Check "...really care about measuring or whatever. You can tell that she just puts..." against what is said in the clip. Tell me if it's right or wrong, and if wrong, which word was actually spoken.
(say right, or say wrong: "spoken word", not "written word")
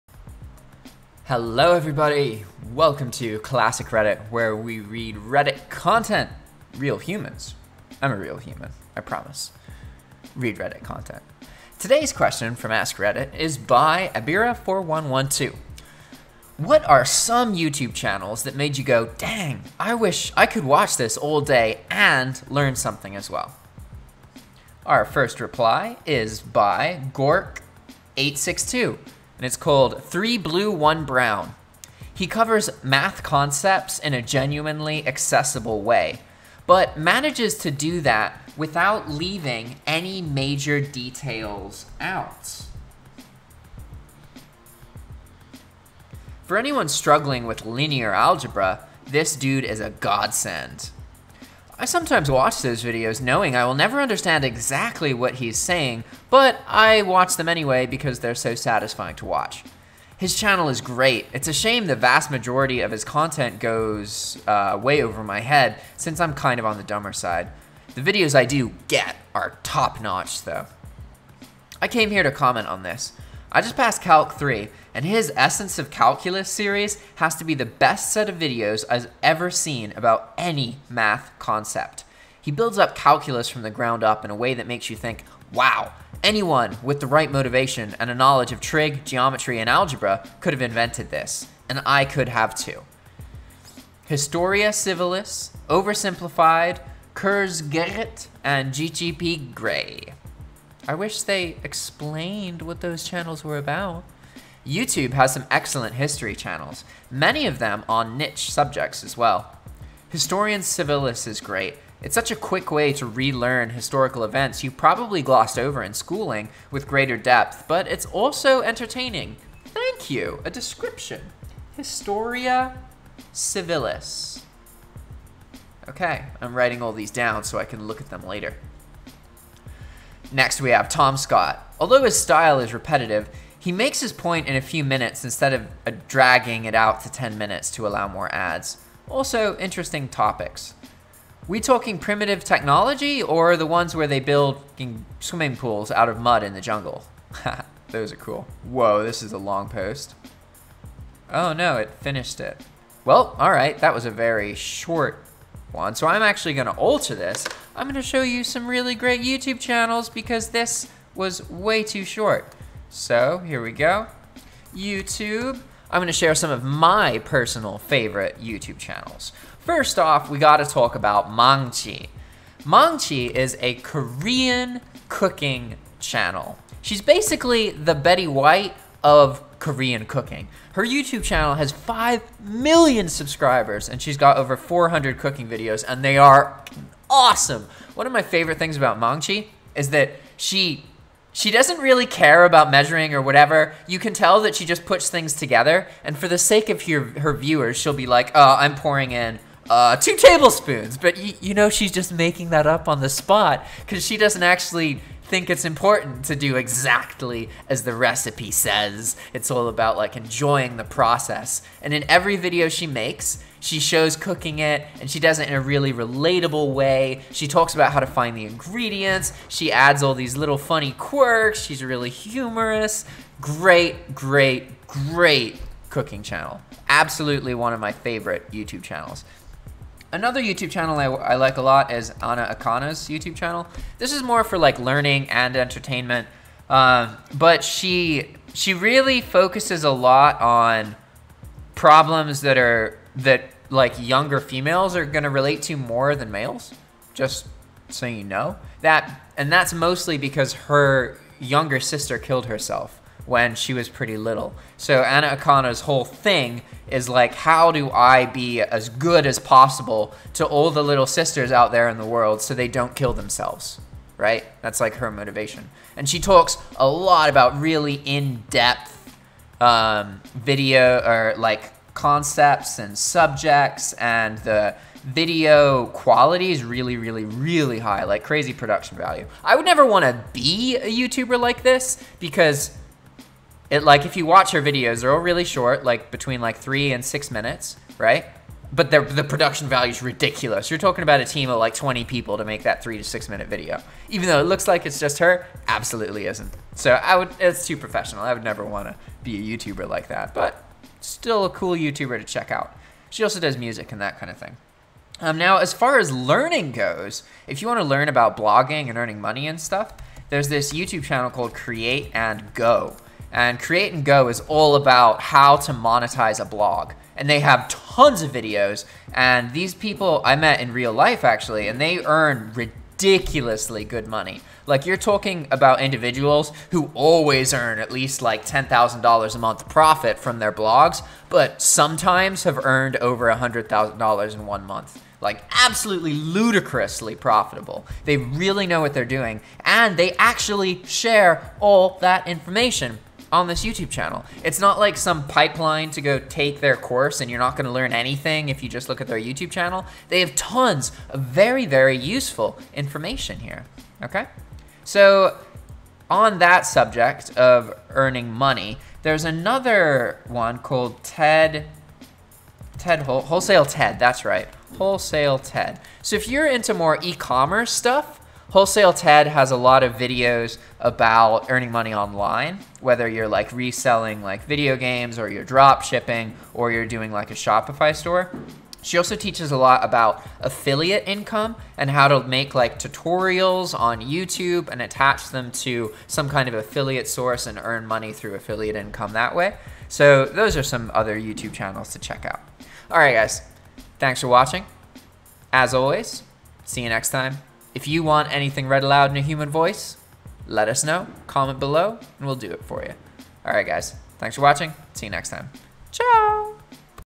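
right.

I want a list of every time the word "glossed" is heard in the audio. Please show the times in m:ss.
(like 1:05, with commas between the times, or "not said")
1:55.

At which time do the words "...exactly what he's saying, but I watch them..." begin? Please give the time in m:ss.
0:54.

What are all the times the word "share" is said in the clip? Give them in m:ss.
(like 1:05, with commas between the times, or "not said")
2:46, 5:40.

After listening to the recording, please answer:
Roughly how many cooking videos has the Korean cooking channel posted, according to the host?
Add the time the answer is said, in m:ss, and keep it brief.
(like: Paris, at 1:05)
over 400, at 3:04.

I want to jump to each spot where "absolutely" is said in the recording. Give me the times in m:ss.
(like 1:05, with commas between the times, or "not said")
3:46, 4:55, 5:35.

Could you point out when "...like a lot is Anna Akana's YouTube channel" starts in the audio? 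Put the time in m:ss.
3:51.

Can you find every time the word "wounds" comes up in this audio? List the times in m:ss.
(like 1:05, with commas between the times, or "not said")
not said.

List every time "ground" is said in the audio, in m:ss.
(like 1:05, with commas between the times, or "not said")
1:23.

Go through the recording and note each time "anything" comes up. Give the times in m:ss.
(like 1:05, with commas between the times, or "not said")
5:47, 6:38.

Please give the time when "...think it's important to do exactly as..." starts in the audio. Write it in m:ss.
3:25.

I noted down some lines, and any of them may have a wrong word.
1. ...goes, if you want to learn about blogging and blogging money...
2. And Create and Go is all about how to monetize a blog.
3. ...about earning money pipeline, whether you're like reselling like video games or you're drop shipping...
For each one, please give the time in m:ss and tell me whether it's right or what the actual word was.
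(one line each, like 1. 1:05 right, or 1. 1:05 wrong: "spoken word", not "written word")
1. 5:06 wrong: "earning", not "blogging"
2. 5:13 right
3. 6:10 wrong: "online", not "pipeline".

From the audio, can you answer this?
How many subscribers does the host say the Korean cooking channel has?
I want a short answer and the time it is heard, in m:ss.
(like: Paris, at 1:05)
5 million, at 3:01.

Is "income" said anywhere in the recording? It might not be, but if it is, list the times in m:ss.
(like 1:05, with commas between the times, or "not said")
6:21, 6:28.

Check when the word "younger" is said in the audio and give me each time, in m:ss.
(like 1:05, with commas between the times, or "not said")
4:03, 4:11.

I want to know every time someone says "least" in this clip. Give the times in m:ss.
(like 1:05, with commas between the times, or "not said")
5:27.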